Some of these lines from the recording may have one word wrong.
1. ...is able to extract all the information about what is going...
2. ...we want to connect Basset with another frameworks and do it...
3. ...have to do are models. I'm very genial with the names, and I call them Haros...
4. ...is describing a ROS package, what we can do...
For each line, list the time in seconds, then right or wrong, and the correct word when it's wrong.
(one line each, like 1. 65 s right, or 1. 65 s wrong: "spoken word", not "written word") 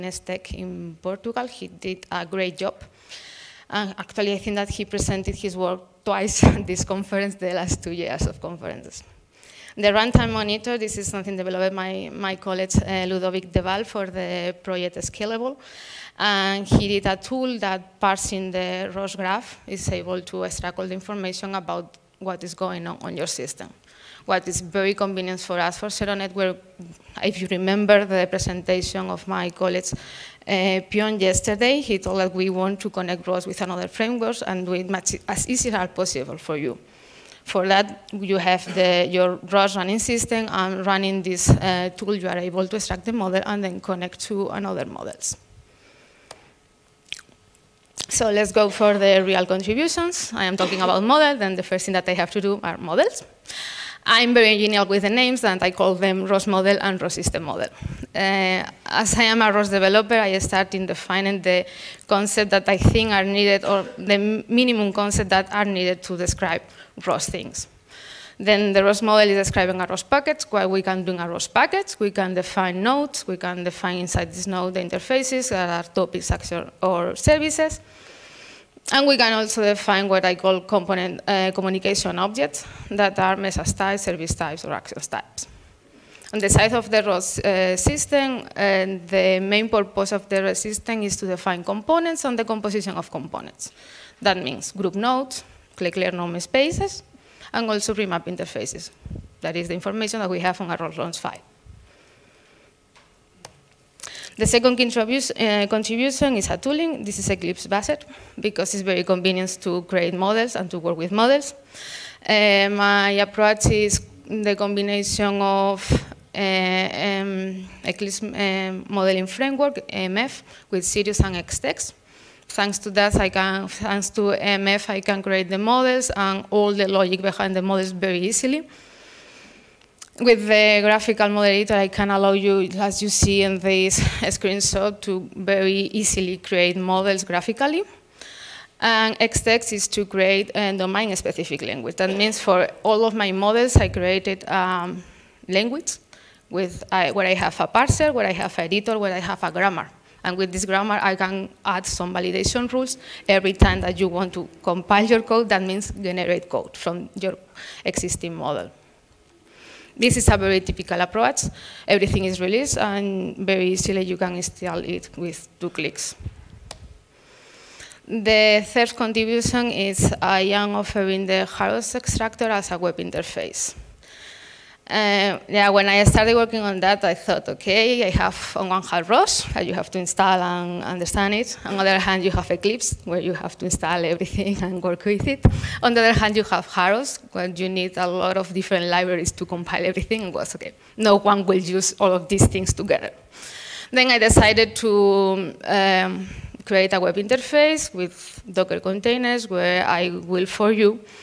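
1. 19 s right
2. 32 s wrong: "ROS", not "Basset"
3. 52 s wrong: "ROS", not "Haros"
4. 69 s right.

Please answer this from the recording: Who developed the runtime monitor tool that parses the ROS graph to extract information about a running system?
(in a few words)
Ludovic Delval.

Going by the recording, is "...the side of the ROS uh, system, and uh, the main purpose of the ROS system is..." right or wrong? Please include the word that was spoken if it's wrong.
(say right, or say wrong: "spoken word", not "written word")
right.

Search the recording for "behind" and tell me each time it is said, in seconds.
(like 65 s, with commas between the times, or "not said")
127 s.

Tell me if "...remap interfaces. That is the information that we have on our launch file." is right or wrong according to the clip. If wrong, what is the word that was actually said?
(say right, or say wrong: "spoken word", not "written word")
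right.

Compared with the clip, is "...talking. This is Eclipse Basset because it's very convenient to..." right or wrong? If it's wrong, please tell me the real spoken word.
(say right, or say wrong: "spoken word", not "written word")
wrong: "tooling", not "talking".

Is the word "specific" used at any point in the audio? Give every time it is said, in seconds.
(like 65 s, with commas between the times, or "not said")
140 s.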